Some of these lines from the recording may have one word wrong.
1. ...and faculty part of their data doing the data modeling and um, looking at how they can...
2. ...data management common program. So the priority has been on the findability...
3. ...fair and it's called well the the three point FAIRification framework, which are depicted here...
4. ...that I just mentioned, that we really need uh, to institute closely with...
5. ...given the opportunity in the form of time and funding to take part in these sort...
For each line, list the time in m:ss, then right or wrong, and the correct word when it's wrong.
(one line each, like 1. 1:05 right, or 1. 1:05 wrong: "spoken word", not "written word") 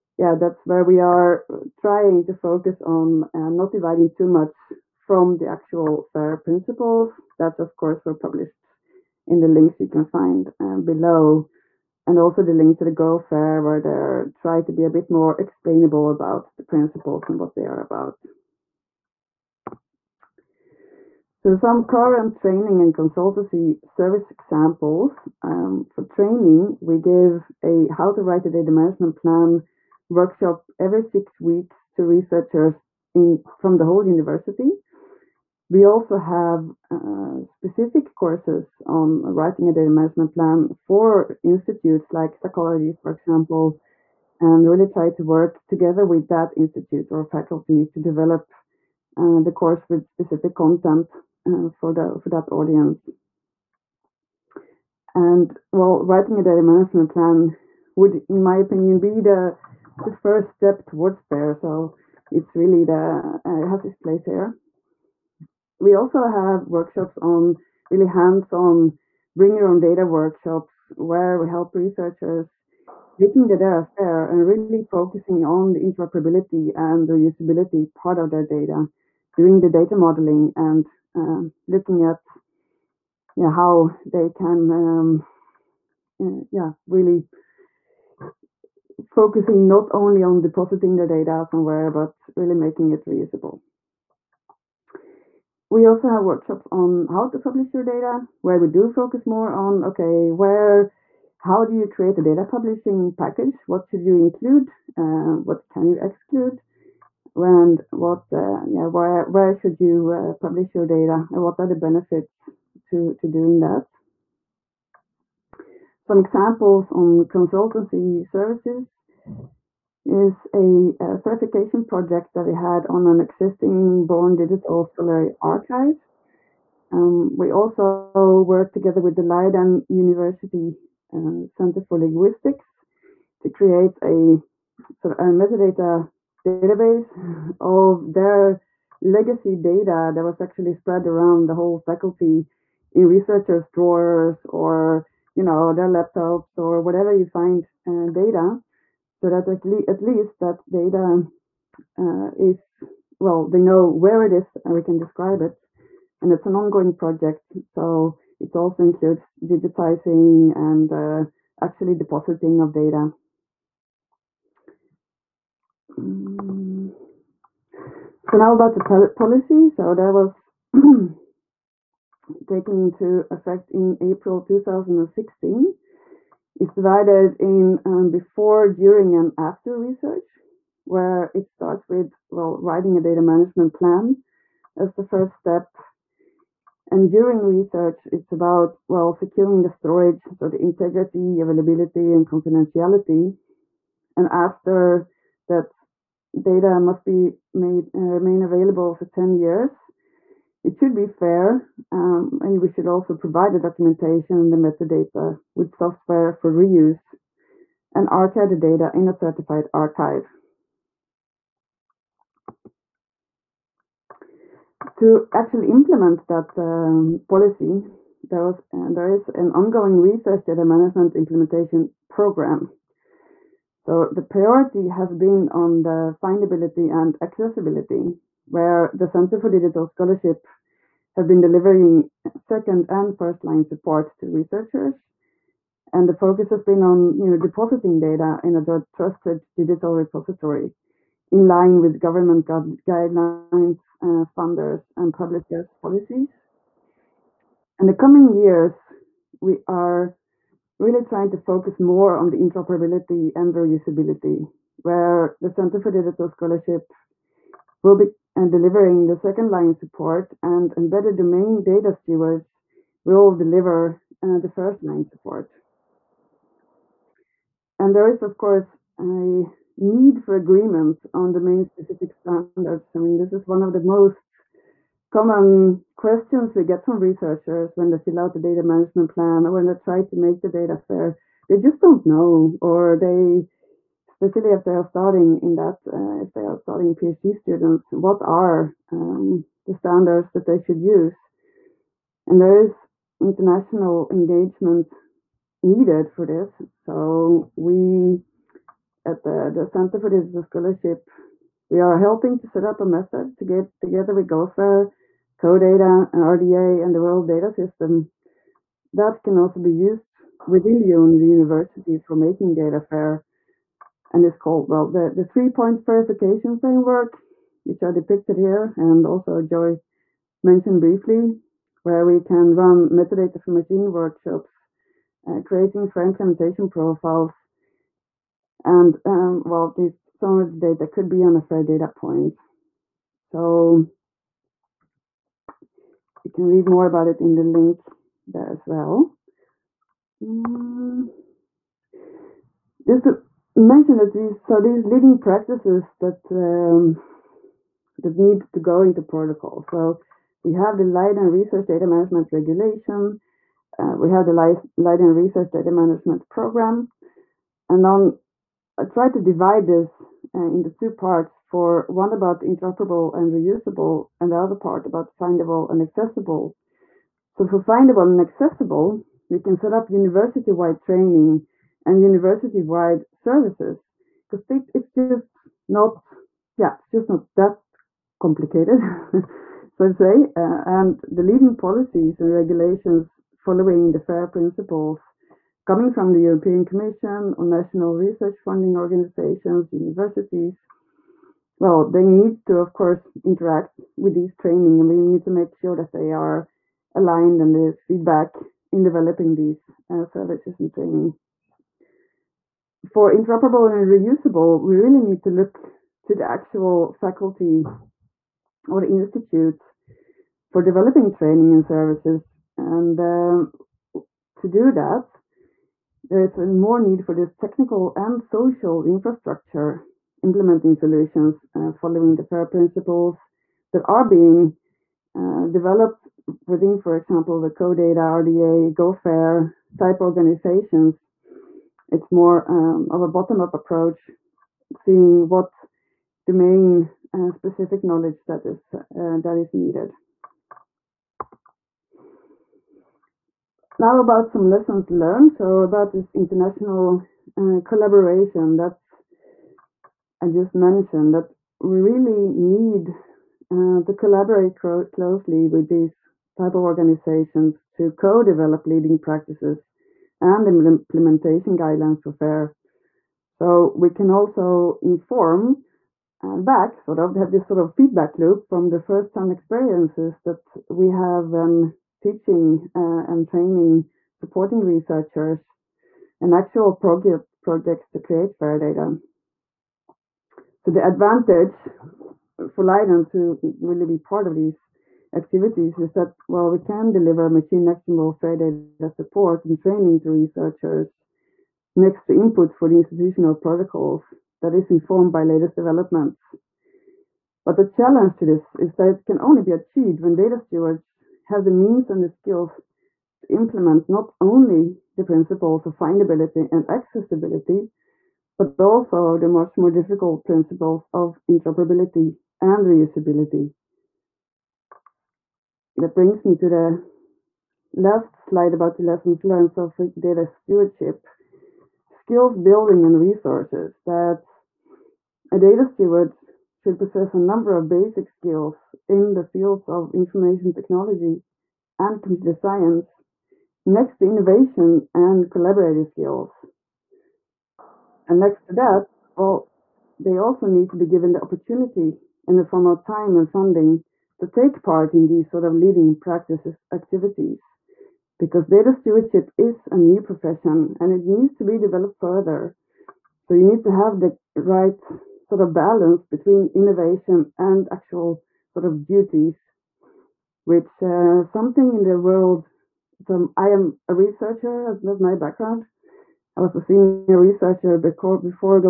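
1. 1:16 wrong: "reusability", not "faculty"
2. 3:40 wrong: "implementation", not "common"
3. 5:12 right
4. 7:28 wrong: "collaborate", not "institute"
5. 9:00 right.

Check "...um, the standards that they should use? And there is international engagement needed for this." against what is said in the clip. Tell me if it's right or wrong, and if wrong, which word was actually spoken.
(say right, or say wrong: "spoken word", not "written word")
right.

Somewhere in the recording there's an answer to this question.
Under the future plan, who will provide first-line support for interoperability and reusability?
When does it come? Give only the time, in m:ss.
4:20.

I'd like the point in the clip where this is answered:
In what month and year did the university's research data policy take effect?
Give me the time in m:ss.
2:54.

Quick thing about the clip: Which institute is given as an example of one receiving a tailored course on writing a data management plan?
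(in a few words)
Psychology.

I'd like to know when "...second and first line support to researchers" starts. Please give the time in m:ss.
3:52.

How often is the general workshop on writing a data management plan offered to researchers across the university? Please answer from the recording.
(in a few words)
Every six weeks.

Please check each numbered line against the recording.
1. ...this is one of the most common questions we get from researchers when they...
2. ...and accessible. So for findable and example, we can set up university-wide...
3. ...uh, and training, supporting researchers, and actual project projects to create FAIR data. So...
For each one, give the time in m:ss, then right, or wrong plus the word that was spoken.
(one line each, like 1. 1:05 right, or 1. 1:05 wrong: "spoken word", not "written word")
1. 4:33 right
2. 6:05 wrong: "accessible", not "example"
3. 7:52 right.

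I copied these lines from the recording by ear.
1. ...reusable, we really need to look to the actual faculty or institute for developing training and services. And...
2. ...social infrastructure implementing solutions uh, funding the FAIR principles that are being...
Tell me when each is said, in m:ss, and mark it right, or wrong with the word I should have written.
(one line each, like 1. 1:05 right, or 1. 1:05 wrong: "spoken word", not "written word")
1. 6:43 right
2. 6:58 wrong: "following", not "funding".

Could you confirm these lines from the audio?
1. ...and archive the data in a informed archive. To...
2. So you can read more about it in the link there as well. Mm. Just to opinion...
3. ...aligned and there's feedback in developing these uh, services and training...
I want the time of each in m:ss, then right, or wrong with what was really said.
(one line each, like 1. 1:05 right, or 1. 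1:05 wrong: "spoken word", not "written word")
1. 3:27 wrong: "certified", not "informed"
2. 5:33 wrong: "mention", not "opinion"
3. 6:36 right.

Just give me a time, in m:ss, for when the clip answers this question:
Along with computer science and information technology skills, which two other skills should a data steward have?
8:54.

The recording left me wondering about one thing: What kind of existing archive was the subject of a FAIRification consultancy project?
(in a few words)
Born Digital Scholarly Archive.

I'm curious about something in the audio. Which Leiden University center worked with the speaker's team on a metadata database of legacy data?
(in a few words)
Center for Linguistics.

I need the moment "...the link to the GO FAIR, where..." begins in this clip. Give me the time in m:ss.
0:12.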